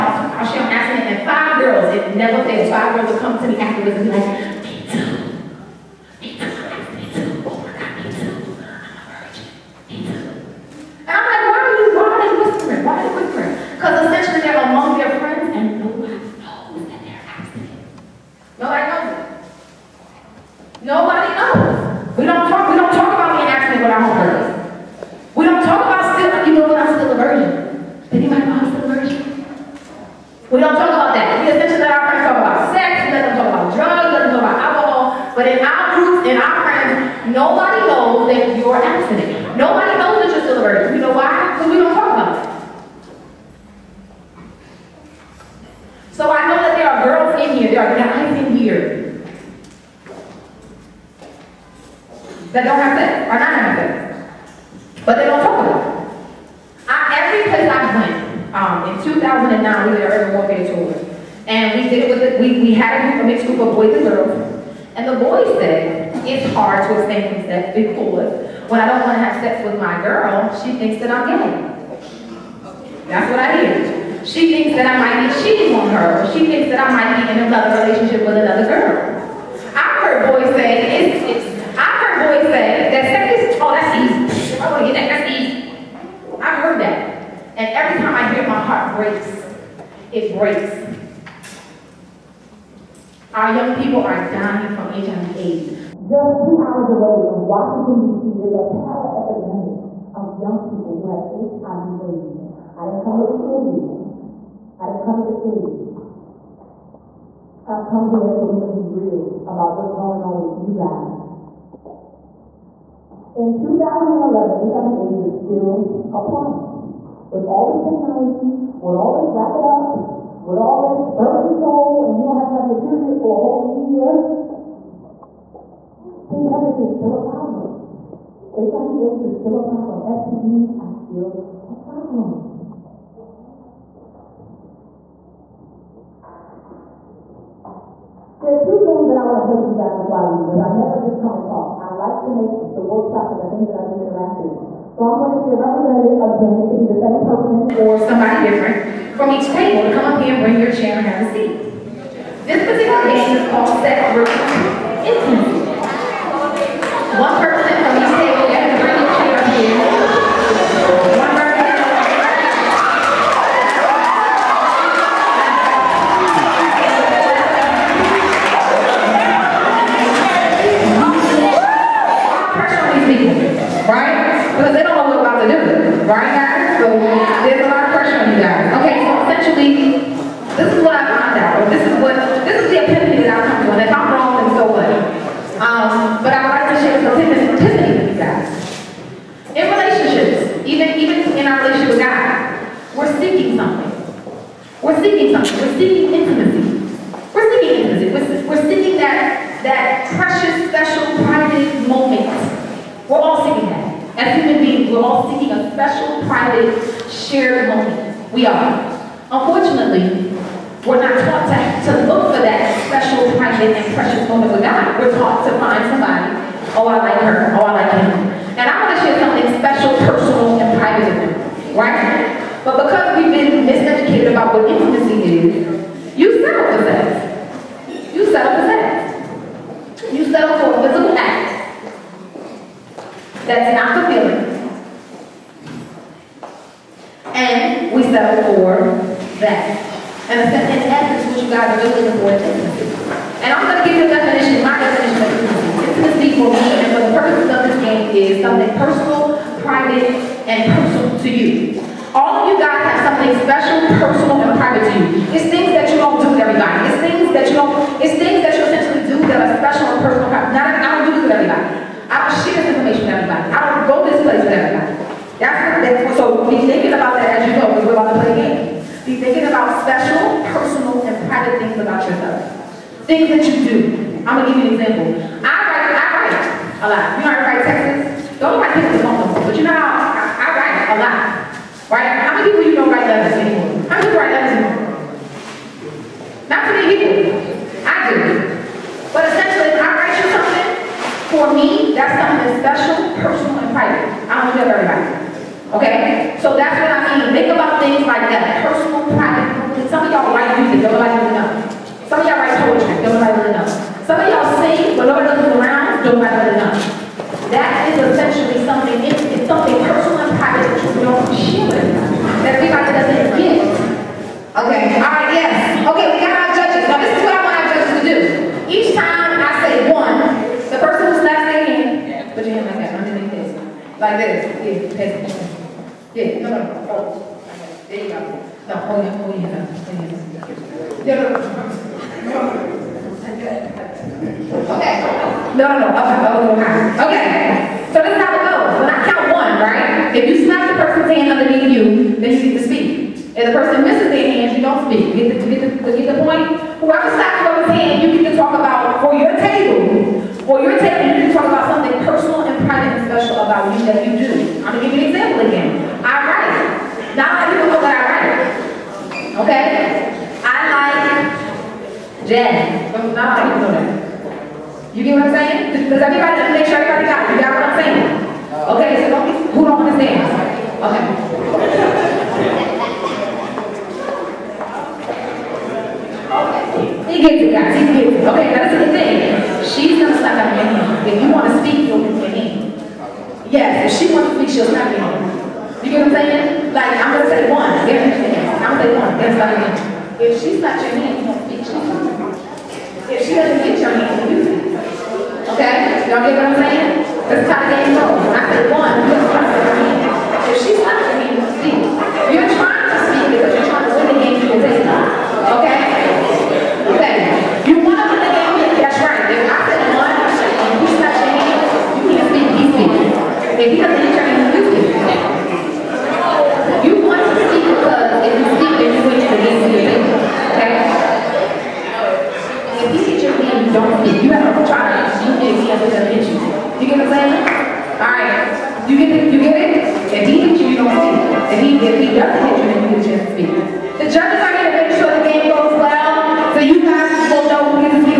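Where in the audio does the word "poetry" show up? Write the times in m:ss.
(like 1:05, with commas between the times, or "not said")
5:02.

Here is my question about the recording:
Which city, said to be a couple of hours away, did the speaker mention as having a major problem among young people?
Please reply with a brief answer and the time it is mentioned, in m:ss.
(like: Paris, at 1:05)
Washington, D.C., at 1:37.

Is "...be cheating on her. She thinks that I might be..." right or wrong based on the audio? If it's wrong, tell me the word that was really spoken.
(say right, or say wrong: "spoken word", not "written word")
right.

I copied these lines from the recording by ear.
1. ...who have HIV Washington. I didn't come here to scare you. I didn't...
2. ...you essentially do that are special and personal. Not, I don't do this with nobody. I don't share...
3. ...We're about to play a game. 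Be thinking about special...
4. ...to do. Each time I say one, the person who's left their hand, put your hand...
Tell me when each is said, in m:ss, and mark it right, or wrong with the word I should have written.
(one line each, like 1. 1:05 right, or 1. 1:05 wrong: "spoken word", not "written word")
1. 1:40 wrong: "AIDS", not "Washington"
2. 4:18 wrong: "everybody", not "nobody"
3. 4:27 right
4. 5:17 right.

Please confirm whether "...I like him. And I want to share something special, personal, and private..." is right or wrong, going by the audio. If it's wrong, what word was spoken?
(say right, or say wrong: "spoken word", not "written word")
right.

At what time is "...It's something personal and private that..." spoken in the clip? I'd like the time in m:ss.
5:09.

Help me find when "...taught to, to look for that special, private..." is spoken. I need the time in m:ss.
3:31.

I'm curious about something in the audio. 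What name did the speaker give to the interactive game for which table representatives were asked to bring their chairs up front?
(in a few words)
Set.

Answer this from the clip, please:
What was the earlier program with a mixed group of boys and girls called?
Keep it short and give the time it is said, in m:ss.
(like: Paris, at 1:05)
urban warfare tour, at 1:00.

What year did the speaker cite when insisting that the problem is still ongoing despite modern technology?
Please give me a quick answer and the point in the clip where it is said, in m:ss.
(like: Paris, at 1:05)
2011, at 1:53.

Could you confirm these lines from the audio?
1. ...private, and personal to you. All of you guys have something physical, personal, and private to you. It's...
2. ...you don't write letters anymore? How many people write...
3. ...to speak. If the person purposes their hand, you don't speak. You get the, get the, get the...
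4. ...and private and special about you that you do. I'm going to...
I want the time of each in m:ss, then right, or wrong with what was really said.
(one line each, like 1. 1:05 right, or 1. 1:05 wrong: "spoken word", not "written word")
1. 4:09 wrong: "special", not "physical"
2. 4:42 right
3. 5:42 wrong: "misses", not "purposes"
4. 5:52 right.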